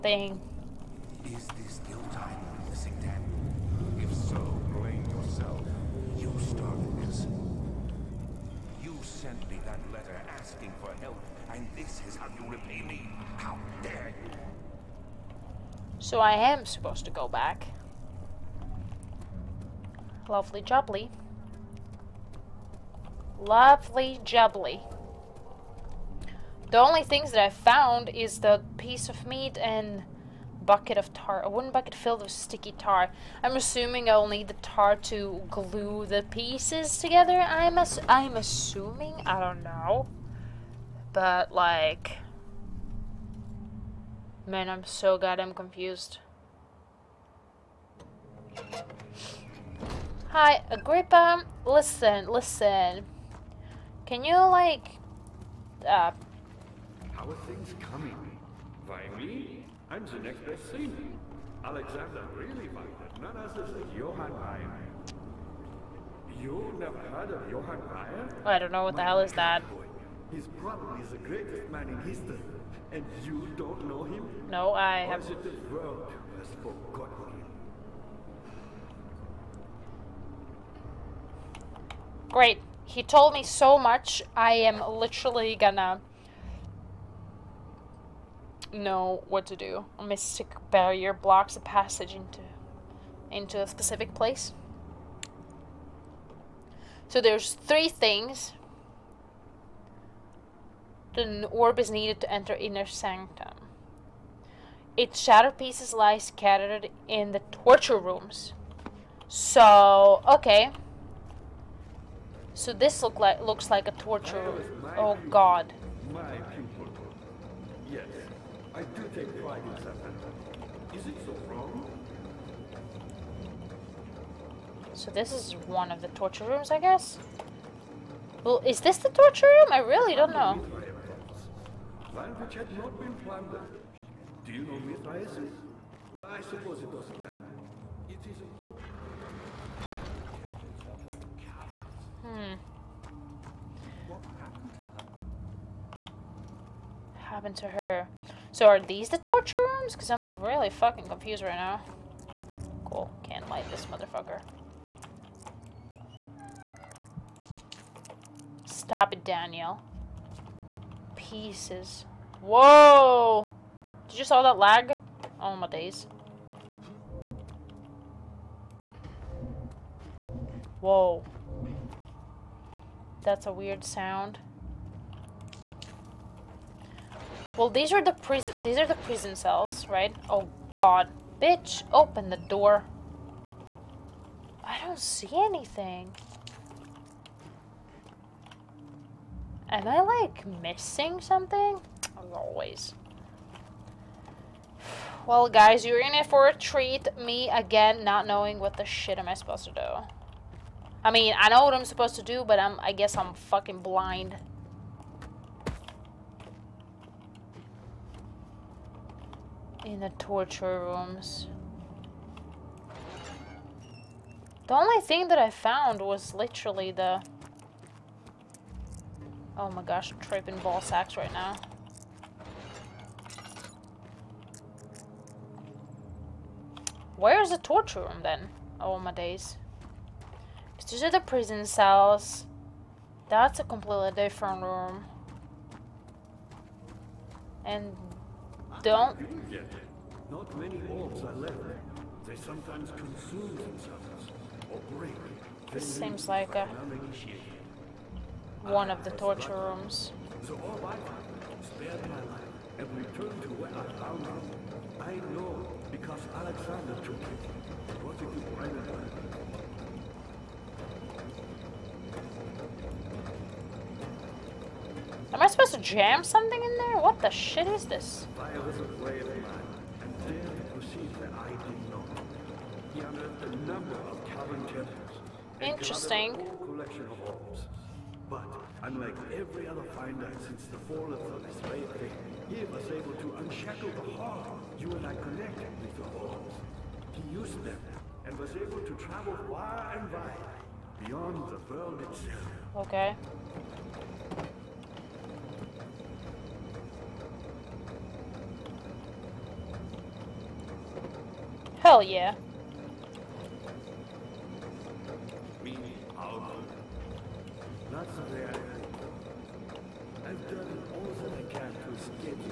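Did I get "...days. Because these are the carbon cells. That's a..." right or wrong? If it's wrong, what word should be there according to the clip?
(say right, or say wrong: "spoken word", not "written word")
wrong: "prison", not "carbon".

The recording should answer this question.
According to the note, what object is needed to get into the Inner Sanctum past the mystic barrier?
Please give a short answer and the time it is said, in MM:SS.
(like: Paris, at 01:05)
An orb, at 01:41.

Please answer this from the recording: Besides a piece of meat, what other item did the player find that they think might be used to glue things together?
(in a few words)
bucket of tar.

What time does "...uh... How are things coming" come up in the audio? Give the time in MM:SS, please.
00:55.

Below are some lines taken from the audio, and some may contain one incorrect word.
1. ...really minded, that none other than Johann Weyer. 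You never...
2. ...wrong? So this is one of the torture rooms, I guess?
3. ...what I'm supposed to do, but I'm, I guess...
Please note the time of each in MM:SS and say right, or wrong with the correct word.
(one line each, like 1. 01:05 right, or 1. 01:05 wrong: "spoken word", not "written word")
1. 01:02 right
2. 02:01 right
3. 03:21 right.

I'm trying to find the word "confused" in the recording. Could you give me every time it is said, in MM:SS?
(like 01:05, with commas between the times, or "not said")
00:45, 02:31.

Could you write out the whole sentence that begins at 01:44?
Its shattered pieces lie scattered in the torture rooms.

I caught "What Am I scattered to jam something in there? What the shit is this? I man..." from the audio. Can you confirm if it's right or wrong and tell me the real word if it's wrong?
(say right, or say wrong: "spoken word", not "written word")
wrong: "supposed", not "scattered".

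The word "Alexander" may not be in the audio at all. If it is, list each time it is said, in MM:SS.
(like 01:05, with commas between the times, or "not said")
01:01, 04:16.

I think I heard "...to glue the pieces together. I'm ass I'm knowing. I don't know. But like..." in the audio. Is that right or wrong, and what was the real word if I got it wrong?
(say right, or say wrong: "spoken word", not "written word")
wrong: "assuming", not "knowing".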